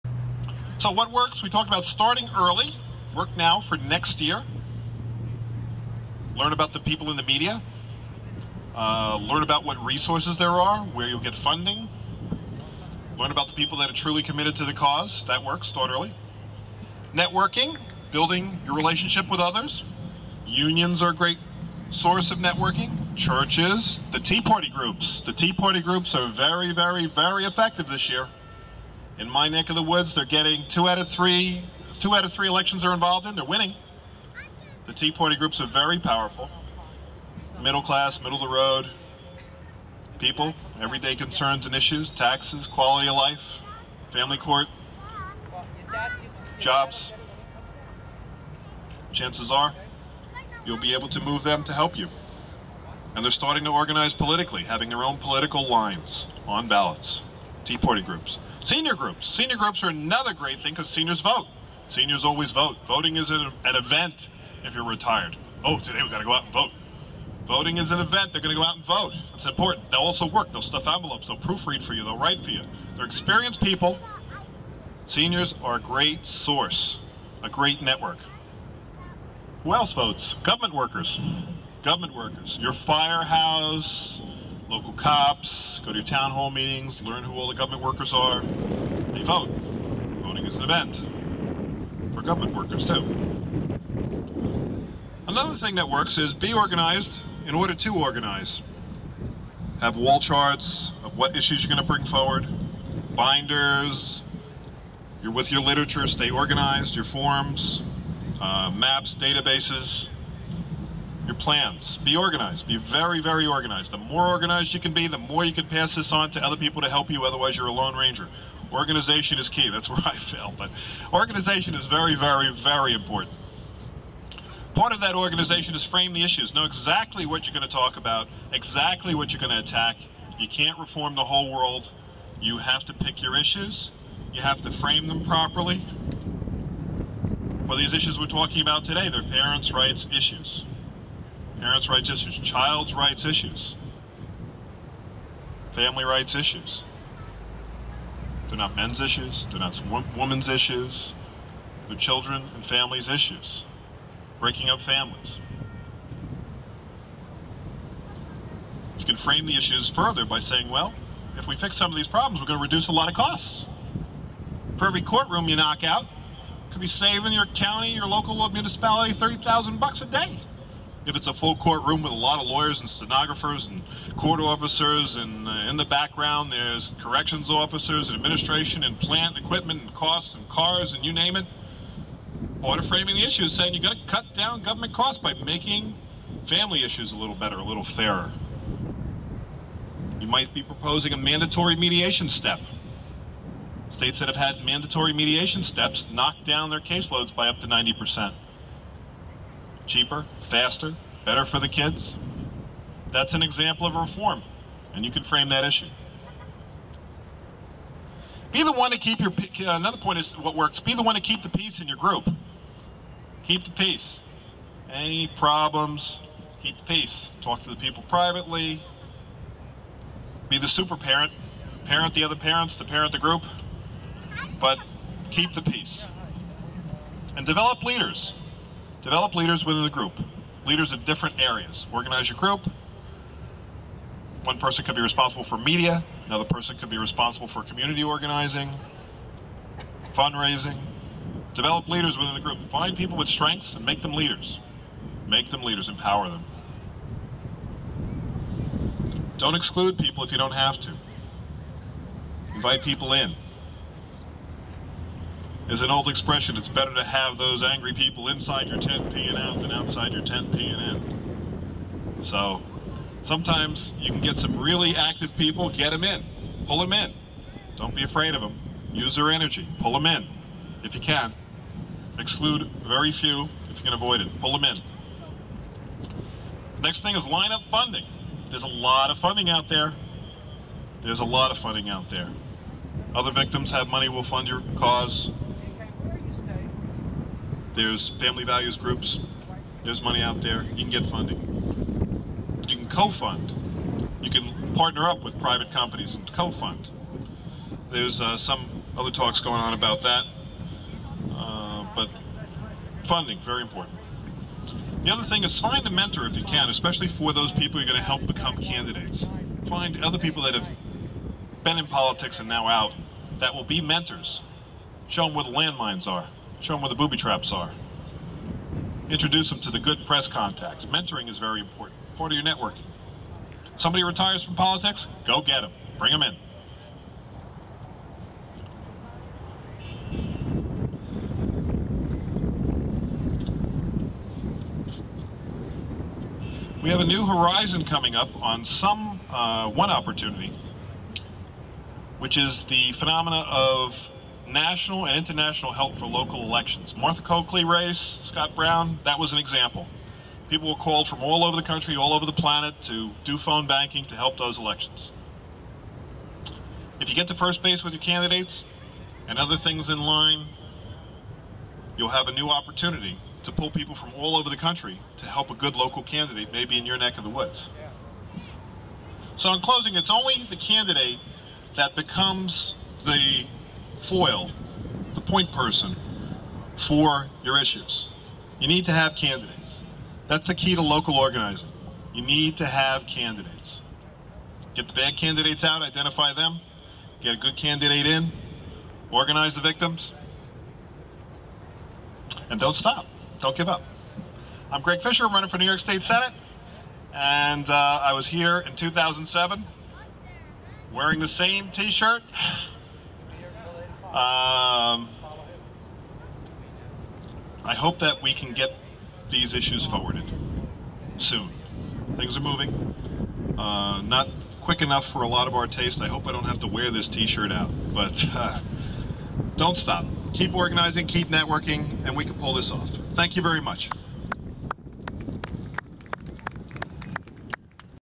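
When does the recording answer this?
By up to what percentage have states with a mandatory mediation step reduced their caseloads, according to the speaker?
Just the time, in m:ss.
3:17.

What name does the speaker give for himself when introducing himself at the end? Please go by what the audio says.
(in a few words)
Greg Fischer.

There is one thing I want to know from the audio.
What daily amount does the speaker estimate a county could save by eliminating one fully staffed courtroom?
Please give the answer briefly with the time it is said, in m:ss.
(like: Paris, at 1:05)
$30,000, at 2:49.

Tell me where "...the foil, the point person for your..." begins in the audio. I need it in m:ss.
6:13.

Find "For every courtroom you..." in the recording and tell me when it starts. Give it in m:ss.
2:44.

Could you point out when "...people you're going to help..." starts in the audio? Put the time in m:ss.
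5:07.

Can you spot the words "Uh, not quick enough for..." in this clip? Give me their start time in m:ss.
6:53.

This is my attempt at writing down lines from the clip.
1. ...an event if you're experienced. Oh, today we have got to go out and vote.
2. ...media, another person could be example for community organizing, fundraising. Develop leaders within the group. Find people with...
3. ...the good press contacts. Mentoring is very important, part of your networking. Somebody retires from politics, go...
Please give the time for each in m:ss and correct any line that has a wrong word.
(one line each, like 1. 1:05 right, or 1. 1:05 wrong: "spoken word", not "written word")
1. 1:03 wrong: "retired", not "experienced"
2. 3:55 wrong: "responsible", not "example"
3. 5:19 right.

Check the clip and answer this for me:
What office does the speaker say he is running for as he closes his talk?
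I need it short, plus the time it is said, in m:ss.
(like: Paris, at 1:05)
New York State Senate, at 6:35.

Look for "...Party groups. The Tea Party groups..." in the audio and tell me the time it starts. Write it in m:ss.
0:24.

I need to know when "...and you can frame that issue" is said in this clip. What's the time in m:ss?
3:24.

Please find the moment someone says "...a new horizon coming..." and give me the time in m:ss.
5:36.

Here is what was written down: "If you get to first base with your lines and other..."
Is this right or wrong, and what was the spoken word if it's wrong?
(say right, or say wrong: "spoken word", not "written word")
wrong: "candidates", not "lines".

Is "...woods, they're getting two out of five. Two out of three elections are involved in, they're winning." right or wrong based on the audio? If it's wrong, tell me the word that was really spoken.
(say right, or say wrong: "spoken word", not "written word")
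wrong: "three", not "five".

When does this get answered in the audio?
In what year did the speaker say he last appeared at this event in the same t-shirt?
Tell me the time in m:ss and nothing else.
6:38.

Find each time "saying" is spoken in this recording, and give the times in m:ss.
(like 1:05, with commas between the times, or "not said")
2:40, 3:03.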